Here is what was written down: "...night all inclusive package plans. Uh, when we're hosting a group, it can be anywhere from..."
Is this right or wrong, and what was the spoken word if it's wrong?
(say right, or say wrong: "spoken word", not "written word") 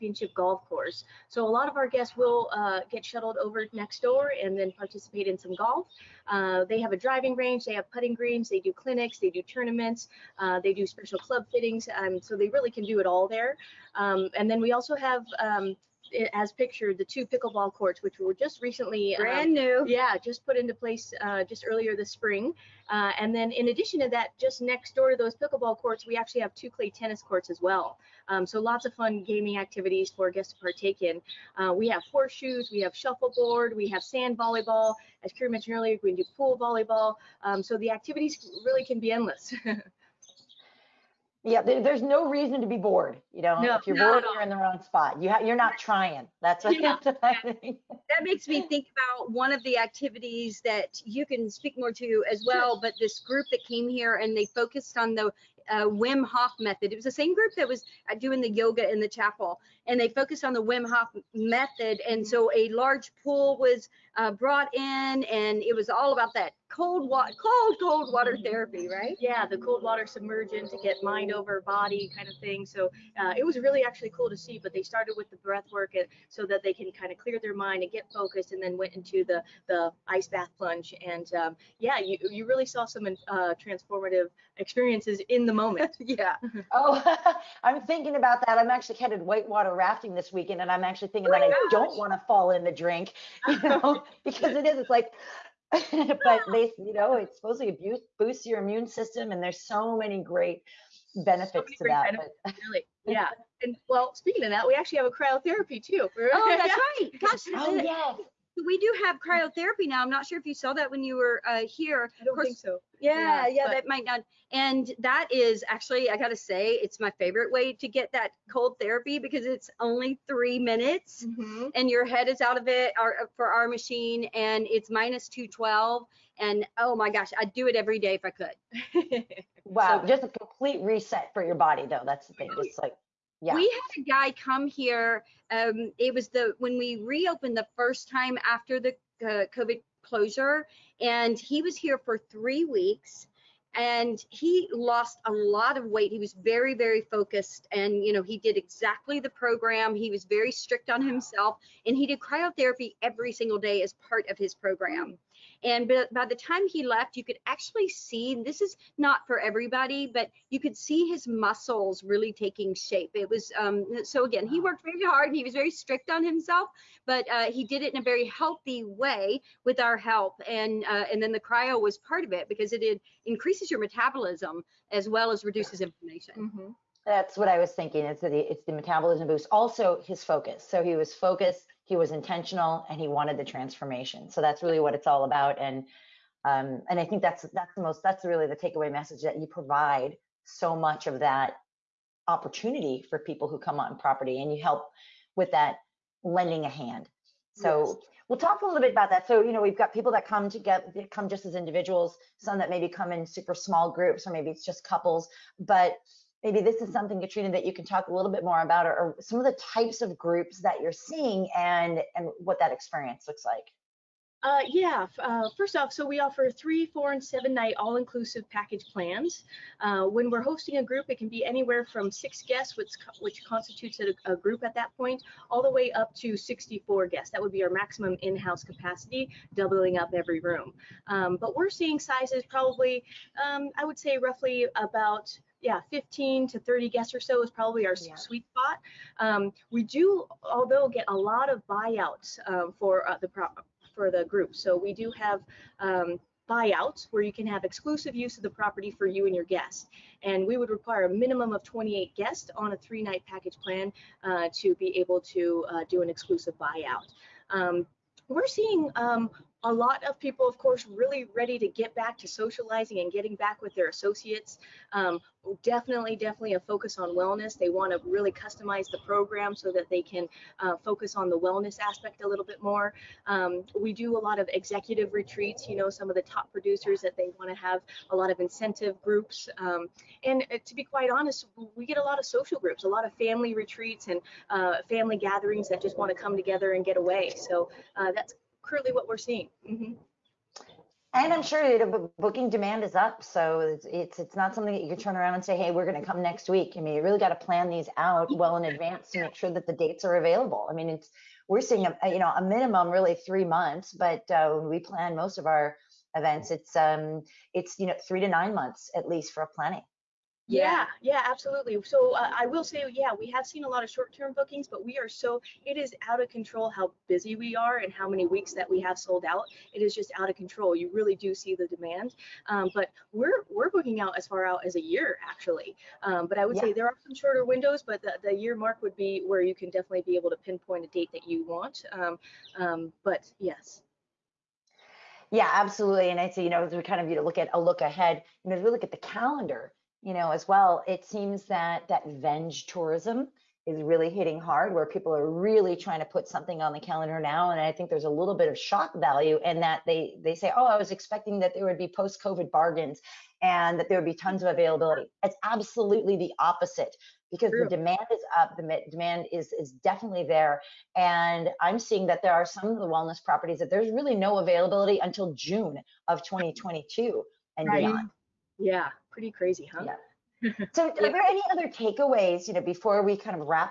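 right.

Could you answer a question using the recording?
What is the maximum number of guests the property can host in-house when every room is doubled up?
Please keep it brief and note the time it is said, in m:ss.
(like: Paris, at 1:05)
64, at 3:46.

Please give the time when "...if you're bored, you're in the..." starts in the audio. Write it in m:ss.
0:43.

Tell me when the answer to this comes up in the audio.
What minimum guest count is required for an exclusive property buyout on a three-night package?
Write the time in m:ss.
4:11.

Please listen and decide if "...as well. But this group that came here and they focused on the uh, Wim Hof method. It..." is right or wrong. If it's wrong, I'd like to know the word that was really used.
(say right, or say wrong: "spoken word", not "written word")
right.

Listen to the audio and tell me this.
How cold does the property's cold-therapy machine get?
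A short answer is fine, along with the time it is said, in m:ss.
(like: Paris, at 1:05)
-212, at 2:04.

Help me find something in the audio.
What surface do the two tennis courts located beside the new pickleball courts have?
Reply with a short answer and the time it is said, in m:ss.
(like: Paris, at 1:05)
clay, at 0:26.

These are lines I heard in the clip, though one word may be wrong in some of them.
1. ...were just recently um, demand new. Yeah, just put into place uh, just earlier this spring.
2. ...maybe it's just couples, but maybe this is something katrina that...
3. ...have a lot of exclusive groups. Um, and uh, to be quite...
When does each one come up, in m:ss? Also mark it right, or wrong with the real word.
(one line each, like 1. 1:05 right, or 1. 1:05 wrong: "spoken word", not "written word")
1. 0:18 wrong: "brand", not "demand"
2. 3:24 right
3. 4:37 wrong: "incentive", not "exclusive".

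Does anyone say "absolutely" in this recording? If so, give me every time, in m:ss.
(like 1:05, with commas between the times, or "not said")
5:11, 5:35, 5:55.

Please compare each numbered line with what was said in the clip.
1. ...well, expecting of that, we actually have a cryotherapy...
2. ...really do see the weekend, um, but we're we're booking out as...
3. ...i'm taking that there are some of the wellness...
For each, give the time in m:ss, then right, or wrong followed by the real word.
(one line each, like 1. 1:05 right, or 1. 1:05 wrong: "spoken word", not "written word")
1. 1:43 wrong: "speaking", not "expecting"
2. 5:20 wrong: "demand", not "weekend"
3. 6:01 wrong: "seeing", not "taking".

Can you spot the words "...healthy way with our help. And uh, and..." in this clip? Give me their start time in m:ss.
2:48.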